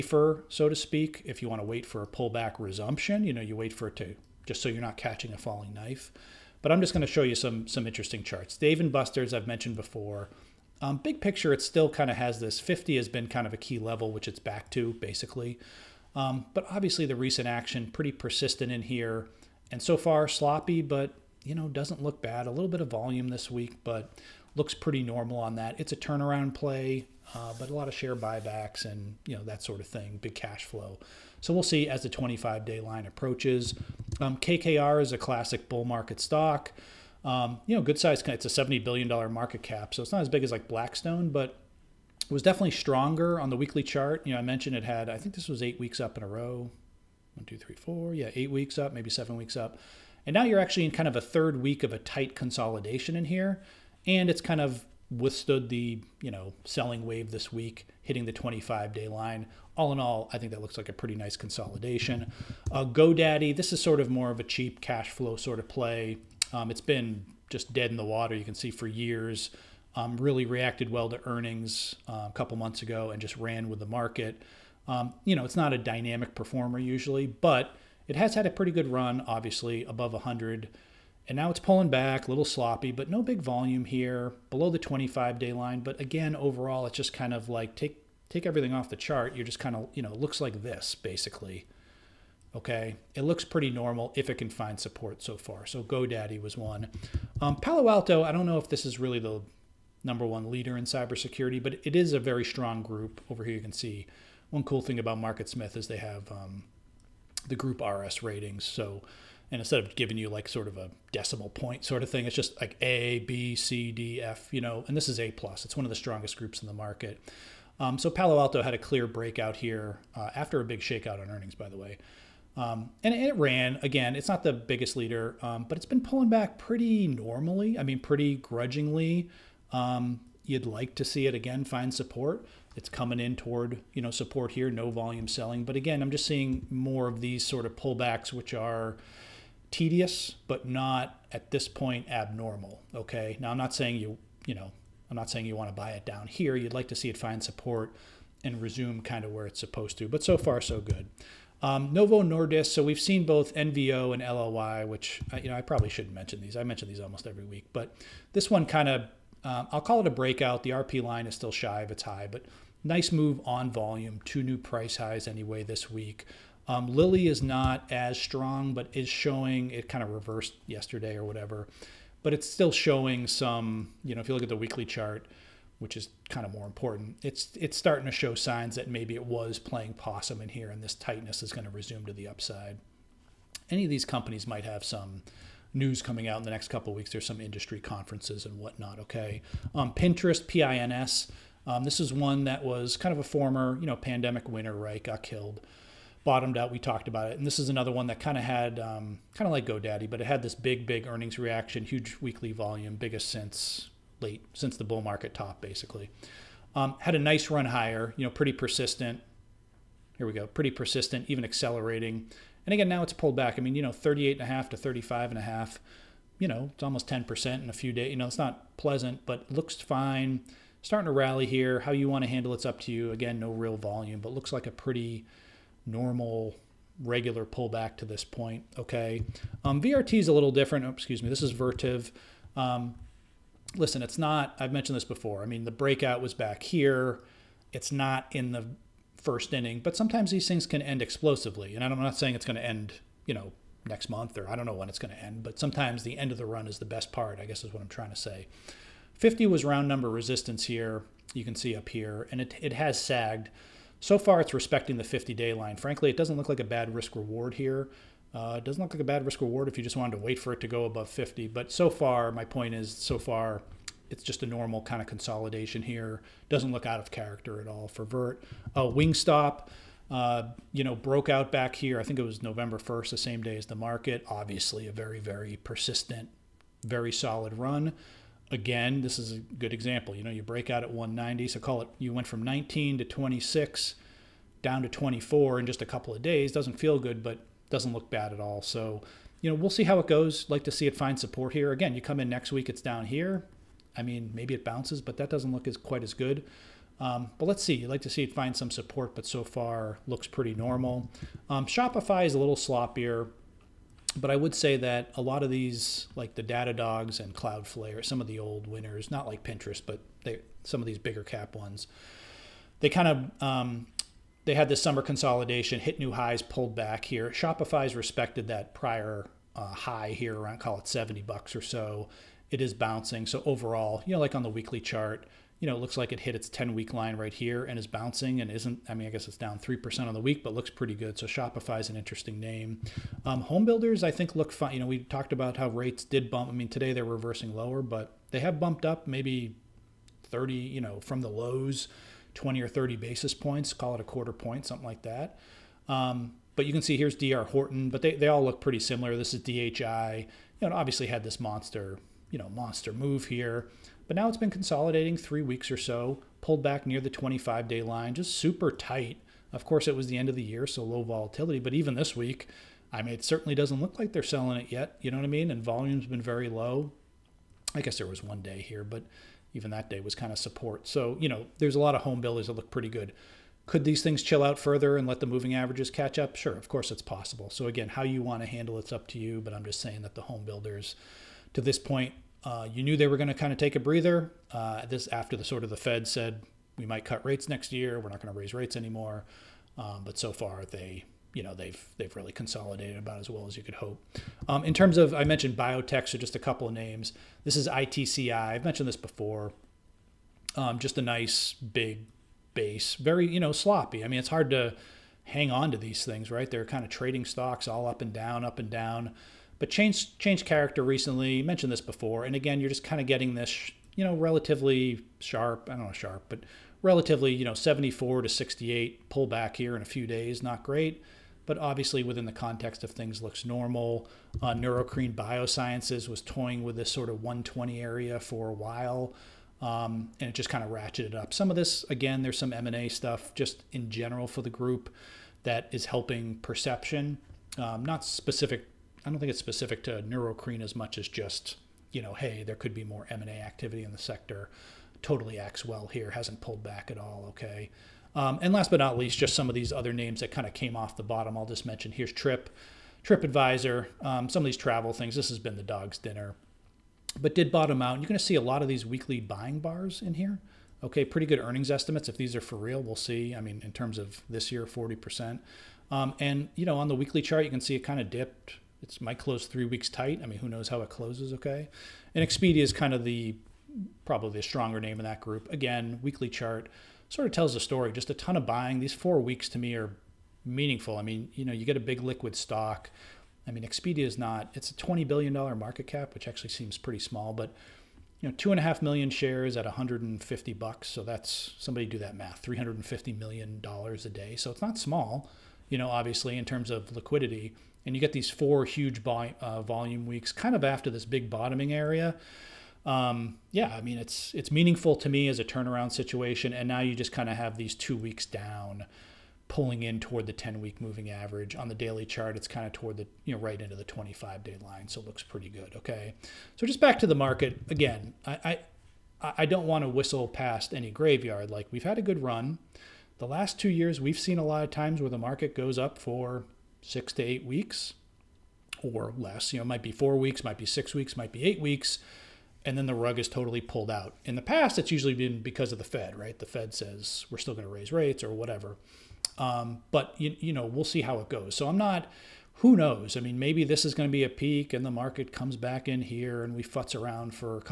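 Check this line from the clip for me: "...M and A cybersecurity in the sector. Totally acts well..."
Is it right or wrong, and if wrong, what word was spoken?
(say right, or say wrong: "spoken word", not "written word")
wrong: "activity", not "cybersecurity".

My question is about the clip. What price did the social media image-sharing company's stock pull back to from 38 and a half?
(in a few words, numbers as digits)
35.5.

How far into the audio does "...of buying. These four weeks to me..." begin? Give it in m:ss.
7:58.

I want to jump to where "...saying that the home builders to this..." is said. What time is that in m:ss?
6:19.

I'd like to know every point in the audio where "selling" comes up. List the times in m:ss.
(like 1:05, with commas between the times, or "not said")
0:56, 2:15, 6:04.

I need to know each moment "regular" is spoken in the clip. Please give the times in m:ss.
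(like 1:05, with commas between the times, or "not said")
3:47.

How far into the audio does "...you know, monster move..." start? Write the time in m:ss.
5:52.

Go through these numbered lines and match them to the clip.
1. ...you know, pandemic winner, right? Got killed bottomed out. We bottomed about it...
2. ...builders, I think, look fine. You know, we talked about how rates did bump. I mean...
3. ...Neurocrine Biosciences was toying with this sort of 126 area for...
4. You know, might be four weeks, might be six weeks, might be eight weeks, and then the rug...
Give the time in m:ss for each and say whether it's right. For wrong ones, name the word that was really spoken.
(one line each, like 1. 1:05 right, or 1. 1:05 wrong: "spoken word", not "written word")
1. 3:13 wrong: "talked", not "bottomed"
2. 5:33 right
3. 7:04 wrong: "120", not "126"
4. 8:49 right.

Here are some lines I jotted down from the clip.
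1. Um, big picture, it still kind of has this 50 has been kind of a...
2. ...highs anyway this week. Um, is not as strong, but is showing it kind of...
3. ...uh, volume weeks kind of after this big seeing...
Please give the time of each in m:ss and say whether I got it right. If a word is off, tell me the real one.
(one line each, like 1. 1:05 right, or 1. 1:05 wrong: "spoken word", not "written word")
1. 0:10 right
2. 2:44 right
3. 8:19 wrong: "bottoming", not "seeing".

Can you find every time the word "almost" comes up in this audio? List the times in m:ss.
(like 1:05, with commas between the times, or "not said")
2:37, 3:36.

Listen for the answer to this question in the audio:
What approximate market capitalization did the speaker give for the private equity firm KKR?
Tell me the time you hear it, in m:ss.
0:38.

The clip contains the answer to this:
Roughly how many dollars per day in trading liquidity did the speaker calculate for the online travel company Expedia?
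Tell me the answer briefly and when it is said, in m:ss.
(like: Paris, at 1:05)
350 million dollars, at 8:12.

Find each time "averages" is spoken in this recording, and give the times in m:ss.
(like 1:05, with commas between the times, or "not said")
6:15, 8:31.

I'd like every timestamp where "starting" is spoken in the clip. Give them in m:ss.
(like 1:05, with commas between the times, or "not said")
2:57, 3:40.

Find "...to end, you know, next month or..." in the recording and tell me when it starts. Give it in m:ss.
4:02.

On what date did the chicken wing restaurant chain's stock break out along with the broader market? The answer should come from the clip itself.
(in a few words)
November 1st.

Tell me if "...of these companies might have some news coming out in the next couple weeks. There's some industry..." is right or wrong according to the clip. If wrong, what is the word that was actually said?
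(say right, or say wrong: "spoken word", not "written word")
right.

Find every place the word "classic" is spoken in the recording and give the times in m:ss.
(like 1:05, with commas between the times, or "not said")
0:35.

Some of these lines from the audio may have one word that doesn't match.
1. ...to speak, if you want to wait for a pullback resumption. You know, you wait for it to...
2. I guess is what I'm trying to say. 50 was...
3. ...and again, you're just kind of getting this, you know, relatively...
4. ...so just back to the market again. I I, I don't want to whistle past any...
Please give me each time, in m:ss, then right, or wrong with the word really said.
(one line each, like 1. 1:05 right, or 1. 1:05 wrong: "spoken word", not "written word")
1. 0:00 right
2. 4:07 right
3. 6:52 right
4. 8:36 right.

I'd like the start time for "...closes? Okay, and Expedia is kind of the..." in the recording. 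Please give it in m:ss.
7:50.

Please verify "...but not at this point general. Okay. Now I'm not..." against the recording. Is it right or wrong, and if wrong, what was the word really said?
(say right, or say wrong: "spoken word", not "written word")
wrong: "abnormal", not "general".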